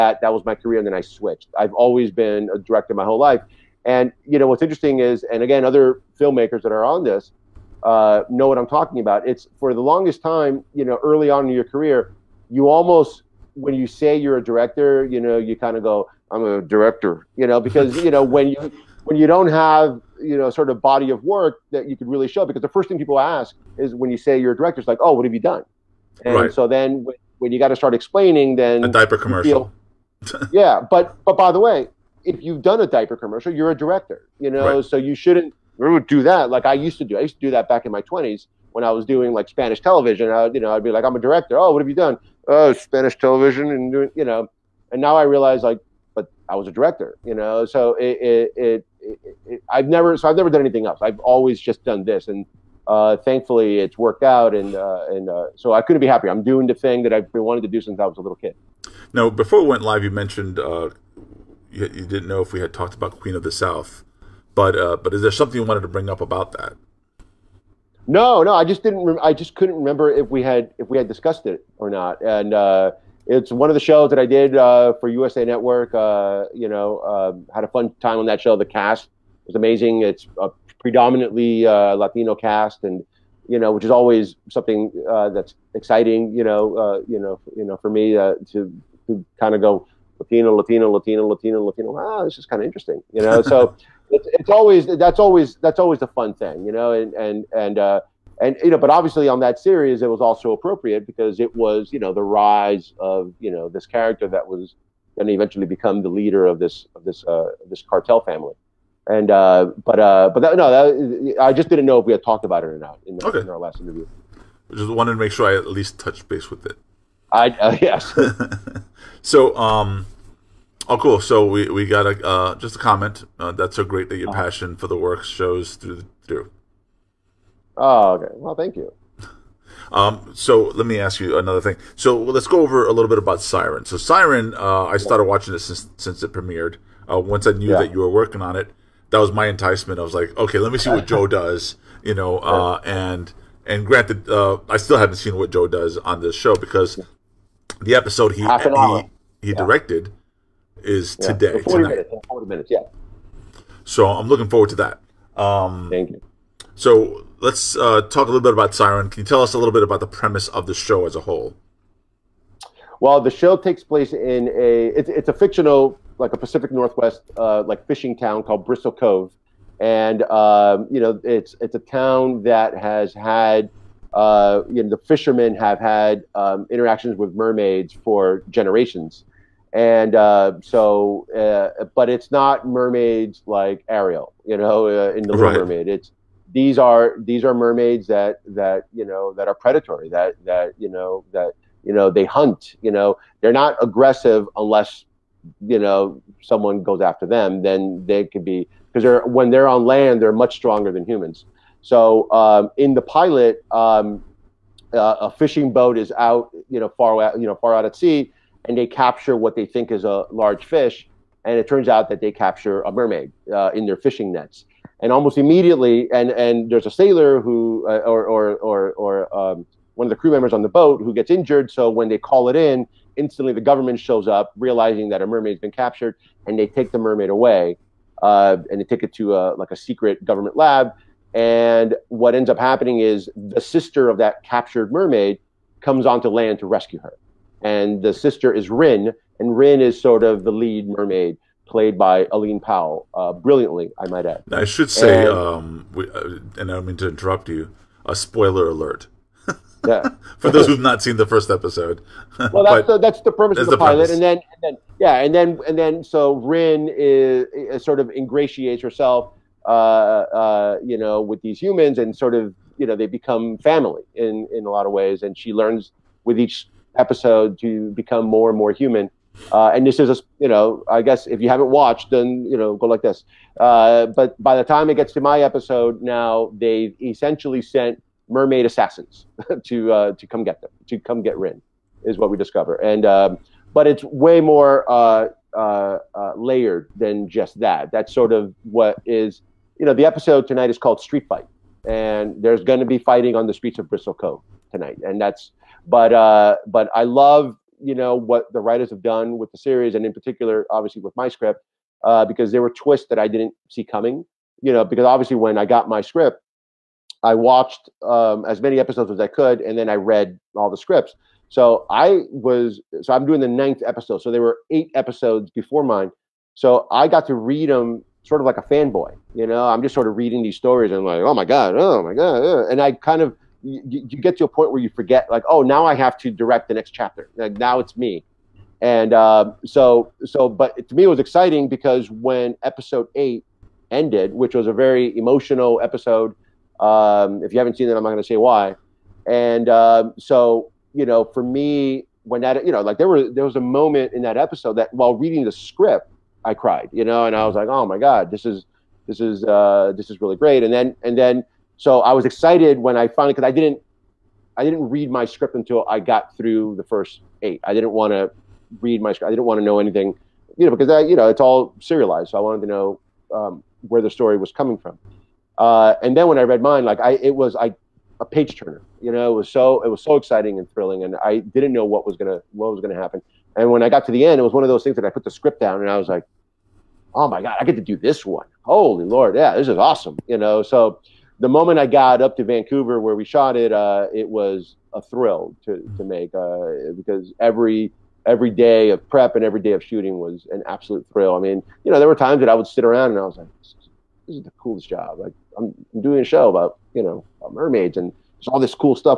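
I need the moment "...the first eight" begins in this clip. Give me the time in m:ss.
5:56.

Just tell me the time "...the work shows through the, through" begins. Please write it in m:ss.
2:04.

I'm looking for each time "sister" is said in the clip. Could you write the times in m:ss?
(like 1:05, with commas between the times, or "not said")
3:53, 3:58.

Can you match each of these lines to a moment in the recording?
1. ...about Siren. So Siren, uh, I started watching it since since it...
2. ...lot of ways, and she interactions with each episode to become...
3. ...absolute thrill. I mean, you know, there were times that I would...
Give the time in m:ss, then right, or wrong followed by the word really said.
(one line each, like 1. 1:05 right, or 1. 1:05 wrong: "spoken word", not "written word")
1. 2:13 right
2. 4:24 wrong: "learns", not "interactions"
3. 6:30 right.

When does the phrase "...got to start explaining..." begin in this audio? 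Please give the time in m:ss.
0:27.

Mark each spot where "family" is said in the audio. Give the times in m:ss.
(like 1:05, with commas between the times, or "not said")
1:48, 4:23.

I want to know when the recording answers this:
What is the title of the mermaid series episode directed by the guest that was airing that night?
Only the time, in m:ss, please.
4:51.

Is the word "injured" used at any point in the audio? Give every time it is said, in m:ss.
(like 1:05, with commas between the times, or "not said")
3:41.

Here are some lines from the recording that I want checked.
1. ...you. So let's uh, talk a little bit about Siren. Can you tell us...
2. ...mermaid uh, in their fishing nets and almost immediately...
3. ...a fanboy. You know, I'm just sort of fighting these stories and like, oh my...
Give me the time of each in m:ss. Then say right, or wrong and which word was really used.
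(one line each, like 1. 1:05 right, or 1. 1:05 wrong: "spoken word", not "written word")
1. 2:36 right
2. 3:32 right
3. 5:18 wrong: "reading", not "fighting".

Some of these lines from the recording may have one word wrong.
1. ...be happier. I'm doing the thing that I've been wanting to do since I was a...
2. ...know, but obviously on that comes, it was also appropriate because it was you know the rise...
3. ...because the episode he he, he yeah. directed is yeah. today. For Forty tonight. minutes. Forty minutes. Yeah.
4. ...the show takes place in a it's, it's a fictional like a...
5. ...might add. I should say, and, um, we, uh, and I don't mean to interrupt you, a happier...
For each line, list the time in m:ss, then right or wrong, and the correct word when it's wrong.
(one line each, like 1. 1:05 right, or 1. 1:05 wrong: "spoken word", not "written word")
1. 0:56 right
2. 1:38 wrong: "series", not "comes"
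3. 2:26 right
4. 2:43 right
5. 4:04 wrong: "spoiler", not "happier".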